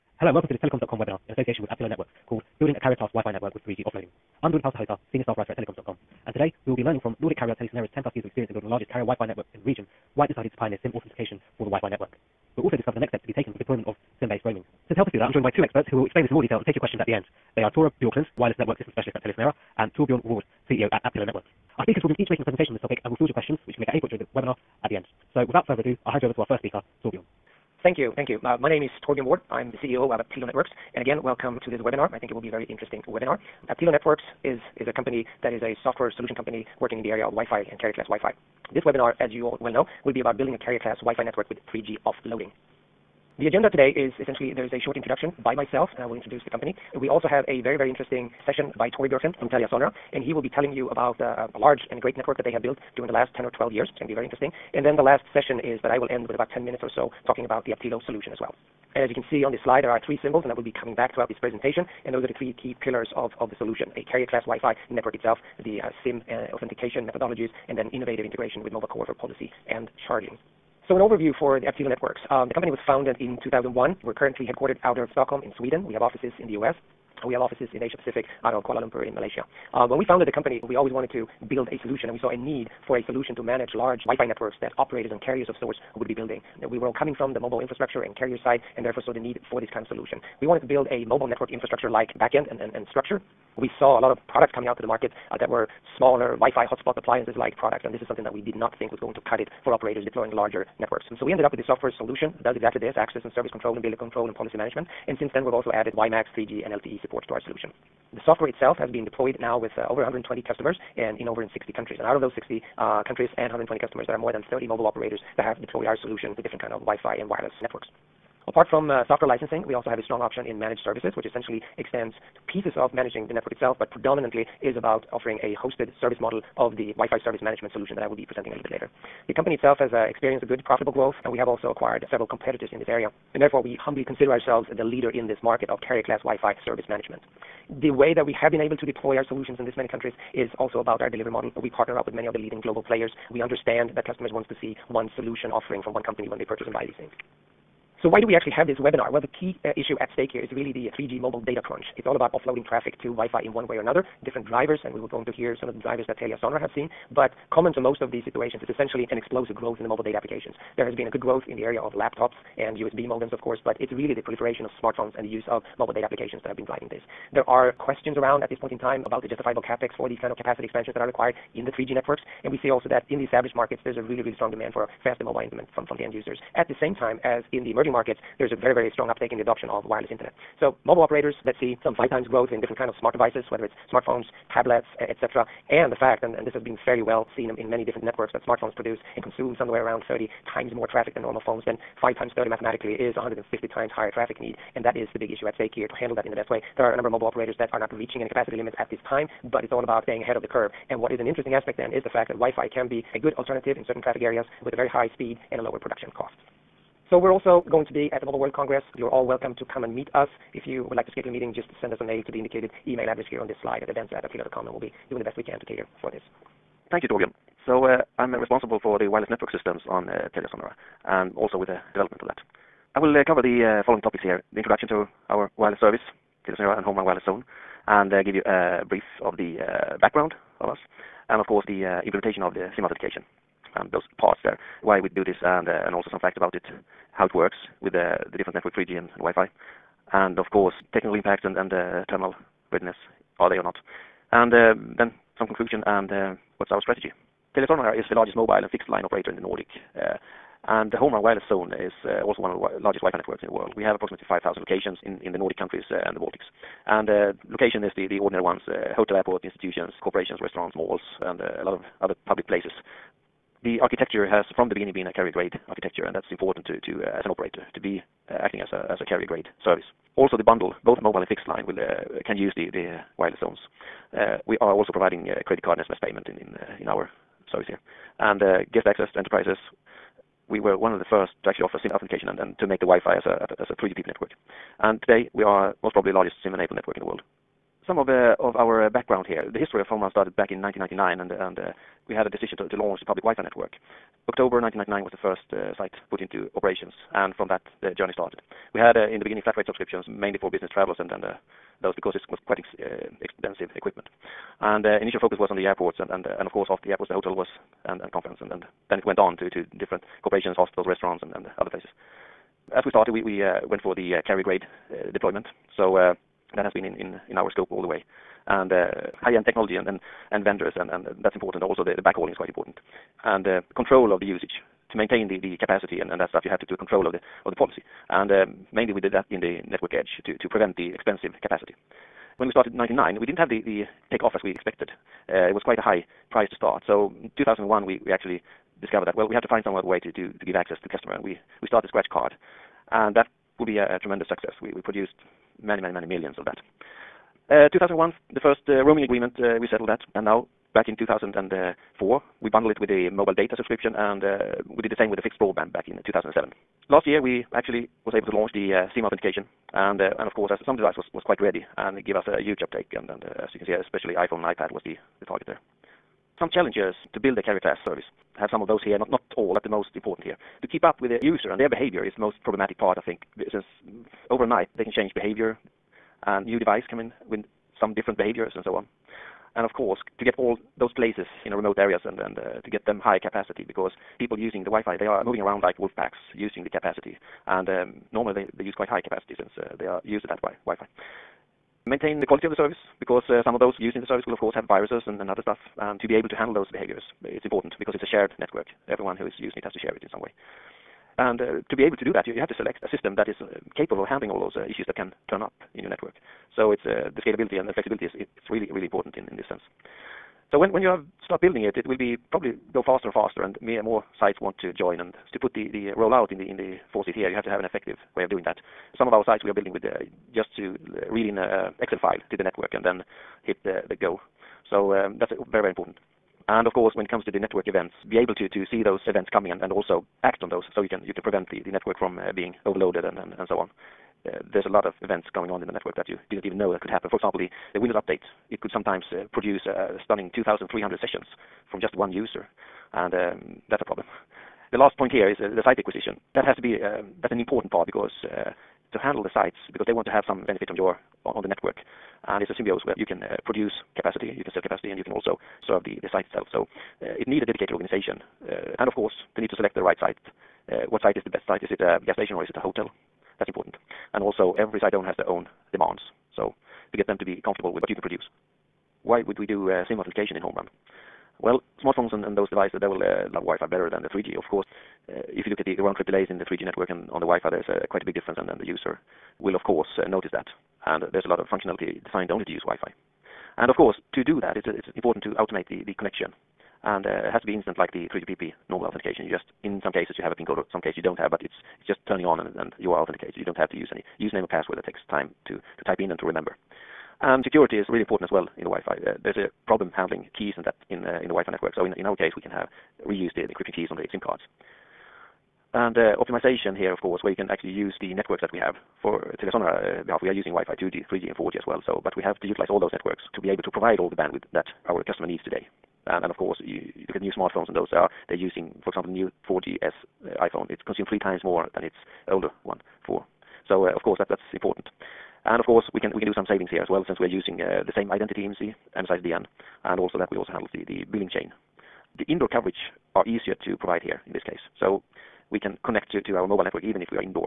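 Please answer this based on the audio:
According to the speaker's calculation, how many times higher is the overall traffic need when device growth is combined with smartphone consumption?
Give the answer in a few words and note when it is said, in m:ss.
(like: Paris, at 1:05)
150, at 3:13.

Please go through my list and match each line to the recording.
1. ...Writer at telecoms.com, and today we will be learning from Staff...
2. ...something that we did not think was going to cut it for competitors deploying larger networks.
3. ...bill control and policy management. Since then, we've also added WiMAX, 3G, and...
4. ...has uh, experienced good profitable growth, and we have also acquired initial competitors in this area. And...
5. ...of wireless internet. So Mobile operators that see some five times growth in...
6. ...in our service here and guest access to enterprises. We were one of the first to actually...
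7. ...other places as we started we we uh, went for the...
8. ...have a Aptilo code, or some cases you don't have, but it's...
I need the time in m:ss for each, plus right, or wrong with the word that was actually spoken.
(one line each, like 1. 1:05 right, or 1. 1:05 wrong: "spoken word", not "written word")
1. 0:05 wrong: "Nordic", not "Staff"
2. 1:38 wrong: "operators", not "competitors"
3. 1:43 right
4. 2:09 wrong: "several", not "initial"
5. 2:59 right
6. 4:36 right
7. 5:11 right
8. 8:10 wrong: "PIN", not "Aptilo".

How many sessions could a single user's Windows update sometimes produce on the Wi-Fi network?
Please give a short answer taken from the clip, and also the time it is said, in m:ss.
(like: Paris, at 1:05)
2,300, at 7:20.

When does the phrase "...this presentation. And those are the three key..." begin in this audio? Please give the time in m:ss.
1:01.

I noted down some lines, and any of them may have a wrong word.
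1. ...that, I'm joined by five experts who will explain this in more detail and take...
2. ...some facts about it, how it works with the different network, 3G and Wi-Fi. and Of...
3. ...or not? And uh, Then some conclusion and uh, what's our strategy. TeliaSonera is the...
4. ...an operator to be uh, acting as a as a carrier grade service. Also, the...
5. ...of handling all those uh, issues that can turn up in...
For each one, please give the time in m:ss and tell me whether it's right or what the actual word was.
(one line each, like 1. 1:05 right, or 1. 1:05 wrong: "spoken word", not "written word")
1. 0:15 wrong: "two", not "five"
2. 3:56 right
3. 4:03 right
4. 4:27 right
5. 6:44 right.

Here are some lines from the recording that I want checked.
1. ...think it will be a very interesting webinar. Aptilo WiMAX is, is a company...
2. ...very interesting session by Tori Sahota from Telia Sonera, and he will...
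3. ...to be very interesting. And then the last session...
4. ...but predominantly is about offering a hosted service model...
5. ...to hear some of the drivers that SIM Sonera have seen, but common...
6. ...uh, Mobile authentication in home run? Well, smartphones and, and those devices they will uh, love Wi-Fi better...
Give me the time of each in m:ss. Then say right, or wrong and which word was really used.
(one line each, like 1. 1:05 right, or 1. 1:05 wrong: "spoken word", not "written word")
1. 0:32 wrong: "Networks", not "WiMAX"
2. 0:47 wrong: "Björklund", not "Sahota"
3. 0:54 right
4. 2:03 right
5. 2:35 wrong: "Telia", not "SIM"
6. 7:49 wrong: "SIM", not "Mobile".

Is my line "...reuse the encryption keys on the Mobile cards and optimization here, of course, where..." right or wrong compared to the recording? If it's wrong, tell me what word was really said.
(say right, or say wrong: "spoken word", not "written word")
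wrong: "SIM", not "Mobile".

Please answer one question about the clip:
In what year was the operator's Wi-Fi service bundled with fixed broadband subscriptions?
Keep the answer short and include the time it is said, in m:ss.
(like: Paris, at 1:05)
2007, at 5:56.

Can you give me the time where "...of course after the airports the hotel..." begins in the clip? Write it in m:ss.
5:06.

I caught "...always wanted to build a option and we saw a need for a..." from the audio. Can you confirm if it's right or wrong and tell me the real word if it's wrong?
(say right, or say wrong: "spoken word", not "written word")
wrong: "solution", not "option".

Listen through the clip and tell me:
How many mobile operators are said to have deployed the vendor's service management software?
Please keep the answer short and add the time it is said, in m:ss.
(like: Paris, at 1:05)
more than 30, at 1:54.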